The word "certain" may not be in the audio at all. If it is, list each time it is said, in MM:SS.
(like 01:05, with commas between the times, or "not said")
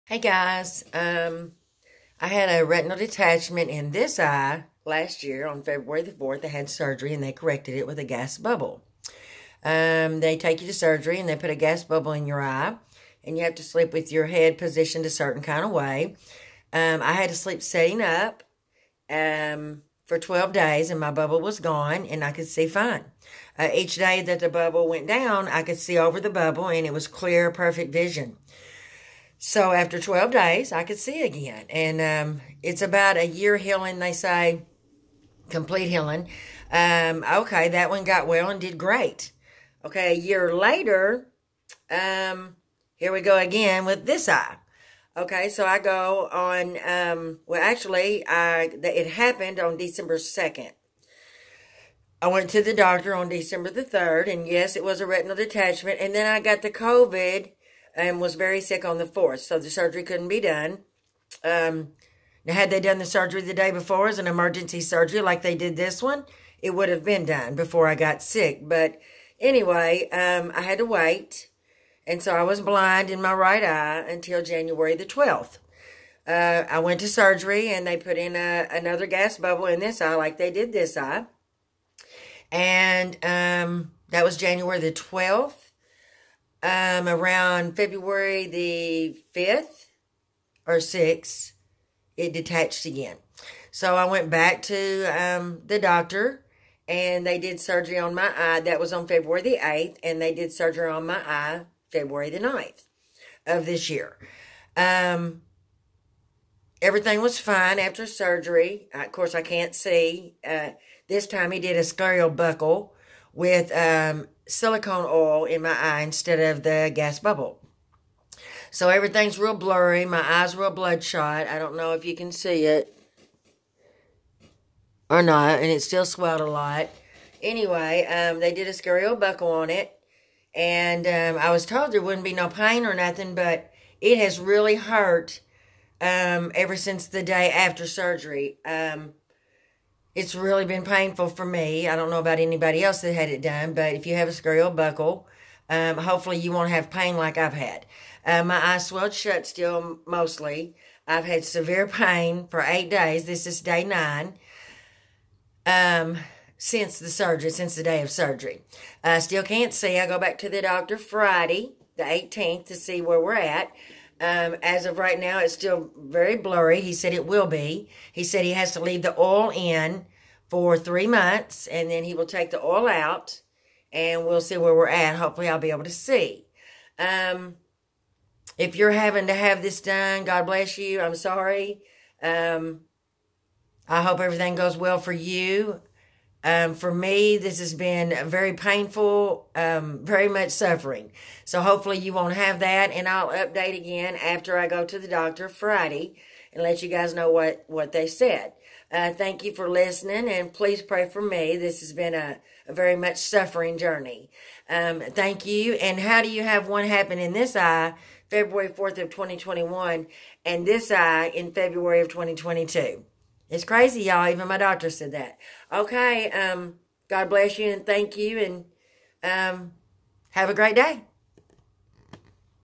00:15.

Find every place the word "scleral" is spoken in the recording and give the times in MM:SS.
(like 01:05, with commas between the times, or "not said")
01:51, 02:24.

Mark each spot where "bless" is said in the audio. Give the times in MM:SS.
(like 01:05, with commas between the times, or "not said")
03:00, 03:37.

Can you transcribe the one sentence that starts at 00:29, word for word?
So after 12 days, I could see again.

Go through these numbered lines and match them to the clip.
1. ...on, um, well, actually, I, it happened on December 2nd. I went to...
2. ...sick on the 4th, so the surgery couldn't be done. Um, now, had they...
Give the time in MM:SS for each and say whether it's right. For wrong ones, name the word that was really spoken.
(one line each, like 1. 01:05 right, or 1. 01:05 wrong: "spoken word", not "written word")
1. 00:46 right
2. 00:58 right.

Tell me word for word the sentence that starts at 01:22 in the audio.
And um, that was January the 12th um, around February the 5th or 6th, it detached again.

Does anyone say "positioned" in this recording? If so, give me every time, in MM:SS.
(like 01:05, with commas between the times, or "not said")
00:14.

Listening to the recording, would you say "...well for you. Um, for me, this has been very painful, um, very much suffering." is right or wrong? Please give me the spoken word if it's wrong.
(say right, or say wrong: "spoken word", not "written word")
right.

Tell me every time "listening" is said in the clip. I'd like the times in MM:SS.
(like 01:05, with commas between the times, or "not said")
03:19.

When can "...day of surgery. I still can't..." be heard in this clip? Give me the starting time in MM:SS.
02:37.